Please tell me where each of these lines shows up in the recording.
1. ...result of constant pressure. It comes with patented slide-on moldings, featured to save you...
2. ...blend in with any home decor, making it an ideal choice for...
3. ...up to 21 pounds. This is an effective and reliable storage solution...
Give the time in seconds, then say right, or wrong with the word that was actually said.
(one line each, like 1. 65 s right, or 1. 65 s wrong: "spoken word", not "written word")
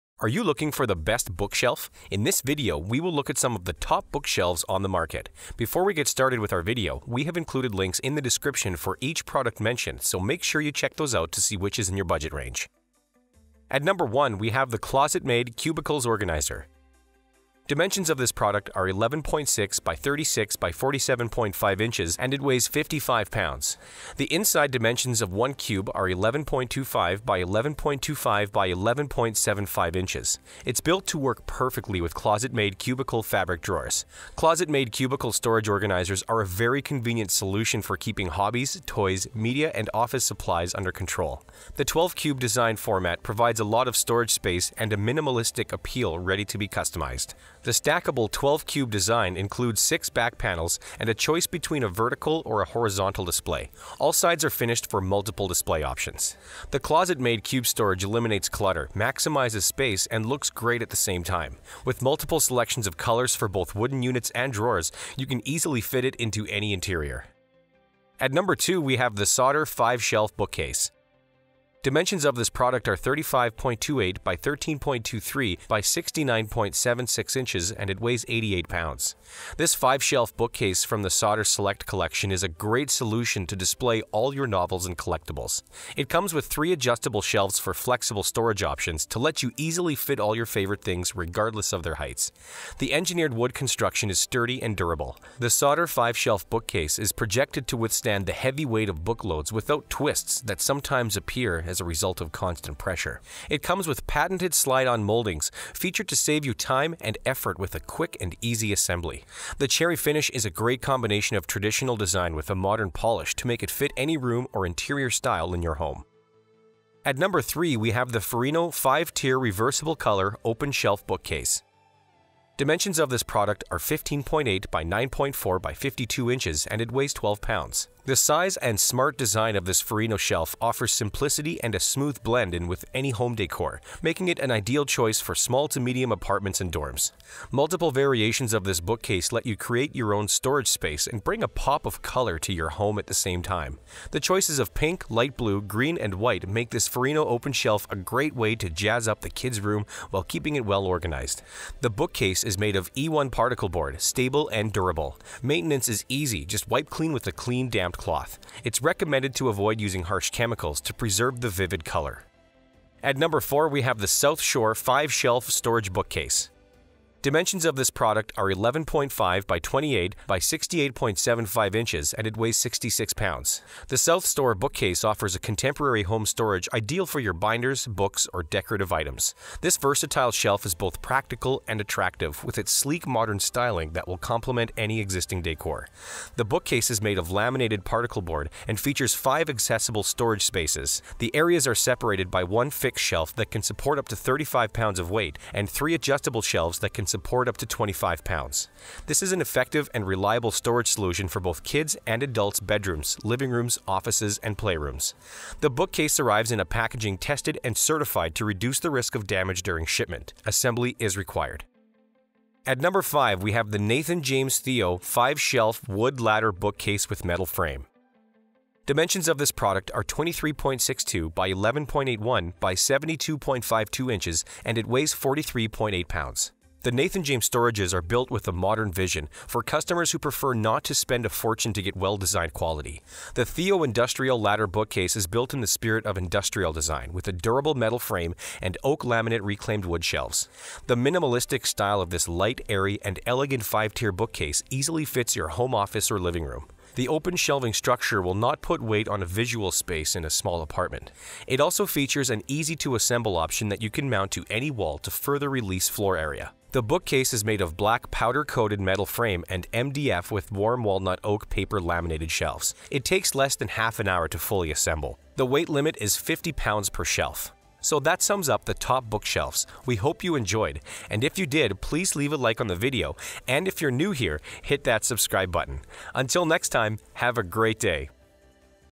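1. 101 s right
2. 132 s right
3. 197 s wrong: "25", not "21".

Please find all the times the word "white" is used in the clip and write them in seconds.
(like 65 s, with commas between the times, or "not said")
146 s.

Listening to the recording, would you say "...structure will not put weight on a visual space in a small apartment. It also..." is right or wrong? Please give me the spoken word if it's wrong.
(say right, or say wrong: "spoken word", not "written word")
right.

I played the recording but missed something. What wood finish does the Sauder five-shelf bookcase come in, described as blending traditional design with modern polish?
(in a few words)
cherry.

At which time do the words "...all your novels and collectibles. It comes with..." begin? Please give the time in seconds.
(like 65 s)
84 s.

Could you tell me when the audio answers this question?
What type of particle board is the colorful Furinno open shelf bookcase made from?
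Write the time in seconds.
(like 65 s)
152 s.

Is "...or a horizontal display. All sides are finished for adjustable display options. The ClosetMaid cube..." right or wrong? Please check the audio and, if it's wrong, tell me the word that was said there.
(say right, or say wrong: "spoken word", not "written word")
wrong: "multiple", not "adjustable".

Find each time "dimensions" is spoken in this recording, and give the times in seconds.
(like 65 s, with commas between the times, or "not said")
17 s, 24 s, 71 s, 122 s, 167 s, 218 s.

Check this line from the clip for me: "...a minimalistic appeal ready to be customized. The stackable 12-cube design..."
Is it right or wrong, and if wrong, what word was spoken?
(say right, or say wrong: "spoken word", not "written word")
right.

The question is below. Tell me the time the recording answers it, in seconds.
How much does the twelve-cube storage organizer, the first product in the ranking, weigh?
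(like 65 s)
22 s.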